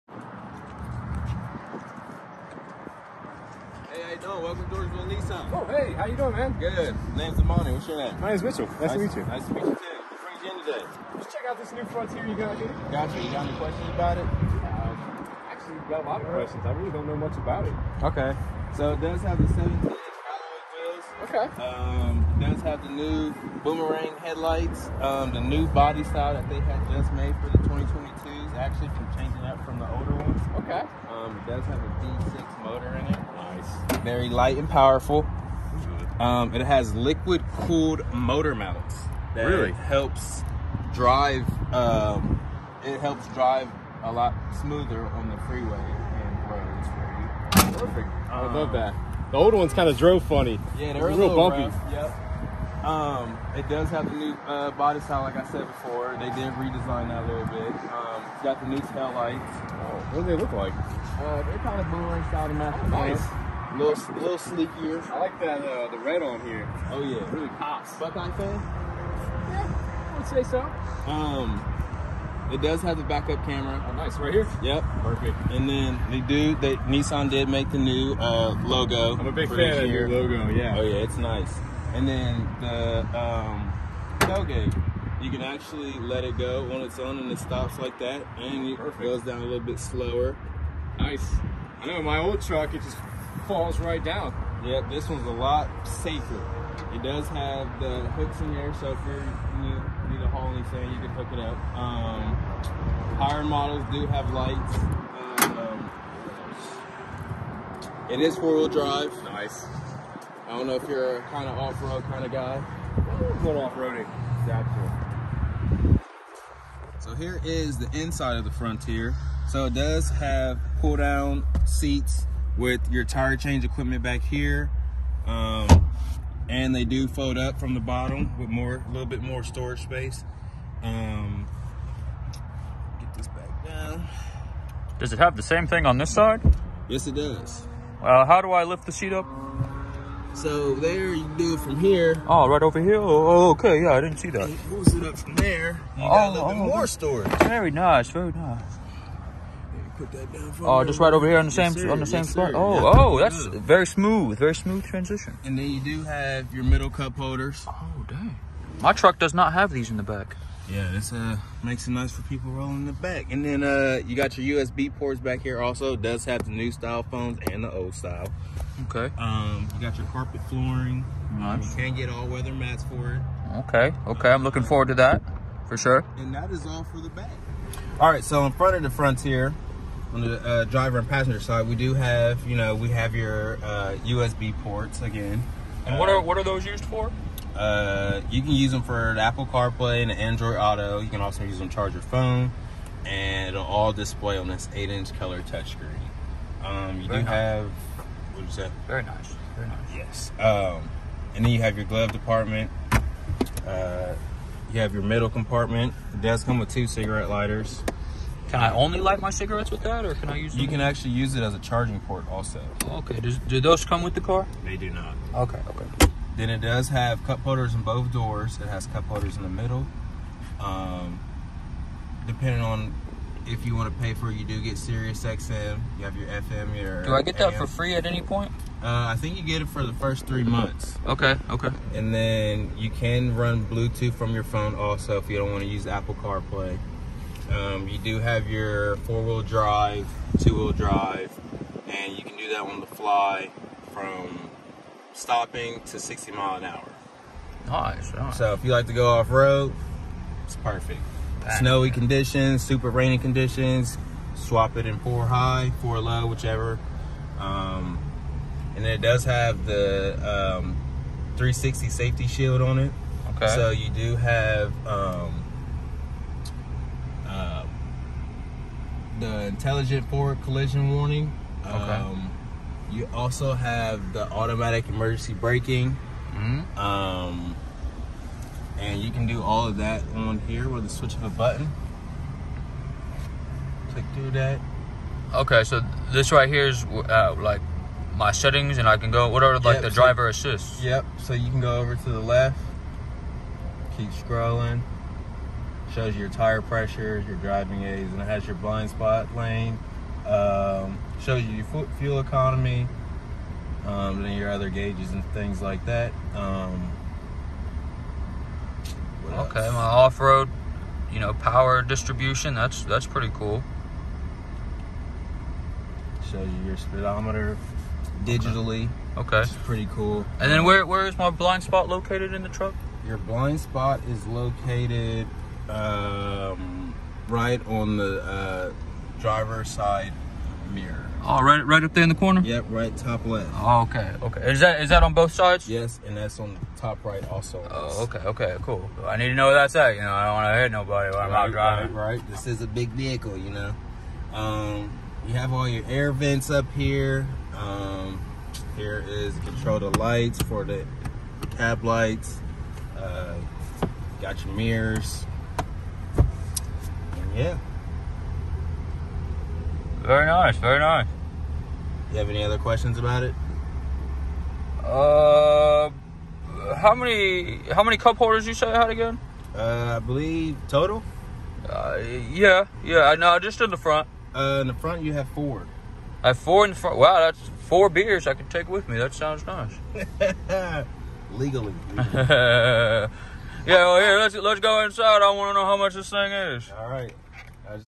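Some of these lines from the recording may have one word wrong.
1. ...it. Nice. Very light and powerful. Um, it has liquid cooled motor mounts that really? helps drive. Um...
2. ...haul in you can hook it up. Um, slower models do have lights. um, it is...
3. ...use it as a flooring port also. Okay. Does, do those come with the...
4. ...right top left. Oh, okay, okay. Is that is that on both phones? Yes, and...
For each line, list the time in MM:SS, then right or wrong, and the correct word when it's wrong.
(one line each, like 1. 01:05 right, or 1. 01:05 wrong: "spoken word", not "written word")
1. 00:33 right
2. 01:40 wrong: "higher", not "slower"
3. 03:31 wrong: "charging", not "flooring"
4. 05:32 wrong: "sides", not "phones".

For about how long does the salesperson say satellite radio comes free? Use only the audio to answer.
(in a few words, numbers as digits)
3 months.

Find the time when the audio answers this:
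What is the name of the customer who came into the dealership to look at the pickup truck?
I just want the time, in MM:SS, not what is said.
00:08.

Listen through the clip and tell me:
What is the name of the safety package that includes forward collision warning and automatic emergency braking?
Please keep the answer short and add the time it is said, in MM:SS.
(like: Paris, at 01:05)
360 safety shield, at 04:21.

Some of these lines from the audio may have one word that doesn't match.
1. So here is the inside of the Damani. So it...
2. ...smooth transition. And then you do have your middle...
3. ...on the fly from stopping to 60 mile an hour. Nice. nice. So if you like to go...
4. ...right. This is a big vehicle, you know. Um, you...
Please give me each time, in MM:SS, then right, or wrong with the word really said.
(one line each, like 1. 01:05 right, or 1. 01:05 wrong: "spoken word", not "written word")
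1. 01:56 wrong: "Frontier", not "Damani"
2. 02:34 right
3. 04:02 right
4. 05:42 right.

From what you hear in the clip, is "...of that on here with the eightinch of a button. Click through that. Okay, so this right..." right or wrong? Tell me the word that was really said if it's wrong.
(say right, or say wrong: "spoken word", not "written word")
wrong: "switch", not "eightinch".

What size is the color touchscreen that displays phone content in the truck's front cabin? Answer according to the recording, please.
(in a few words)
8-inch.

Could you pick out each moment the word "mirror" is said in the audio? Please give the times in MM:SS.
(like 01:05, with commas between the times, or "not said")
05:30, 05:54.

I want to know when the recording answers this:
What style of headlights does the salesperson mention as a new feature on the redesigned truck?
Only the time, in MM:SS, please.
00:23.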